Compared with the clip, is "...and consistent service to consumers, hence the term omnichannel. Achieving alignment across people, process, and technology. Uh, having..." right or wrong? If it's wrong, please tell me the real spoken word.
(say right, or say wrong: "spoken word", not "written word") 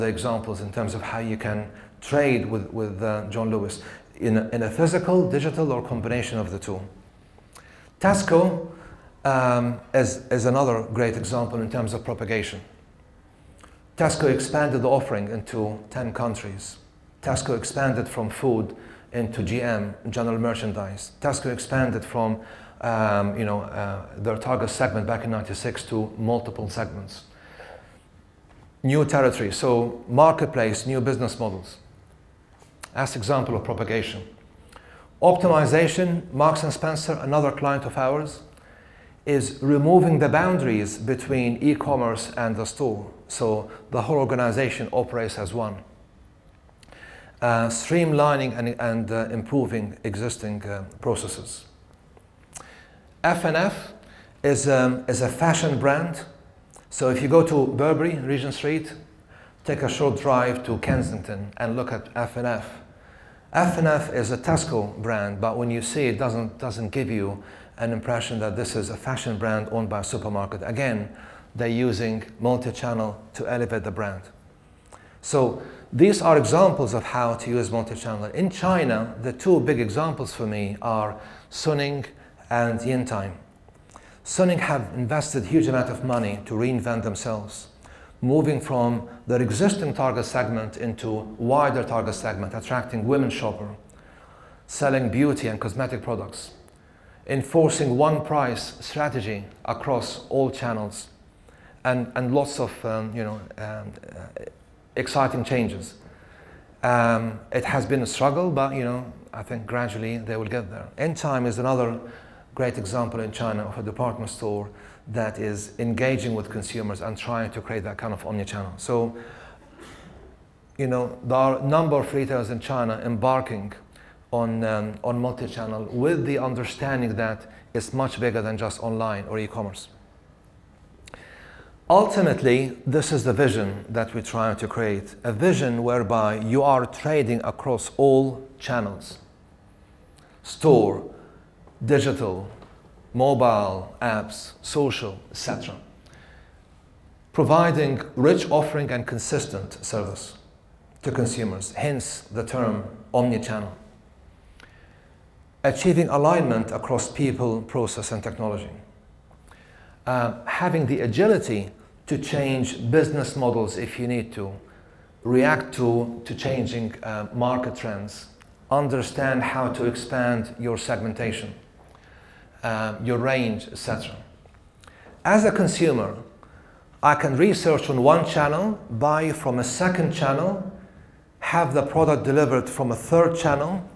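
right.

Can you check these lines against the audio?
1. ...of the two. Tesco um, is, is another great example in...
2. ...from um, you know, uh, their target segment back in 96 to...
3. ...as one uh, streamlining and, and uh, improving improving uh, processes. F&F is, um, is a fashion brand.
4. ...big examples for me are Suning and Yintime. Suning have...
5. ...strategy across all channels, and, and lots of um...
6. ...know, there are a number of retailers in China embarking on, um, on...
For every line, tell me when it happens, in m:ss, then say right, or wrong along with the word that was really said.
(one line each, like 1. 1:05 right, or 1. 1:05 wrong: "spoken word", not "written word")
1. 0:06 right
2. 0:22 right
3. 0:45 wrong: "existing", not "improving"
4. 1:19 right
5. 1:38 right
6. 2:00 right.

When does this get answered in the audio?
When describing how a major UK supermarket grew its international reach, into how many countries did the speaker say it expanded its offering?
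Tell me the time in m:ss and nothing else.
0:15.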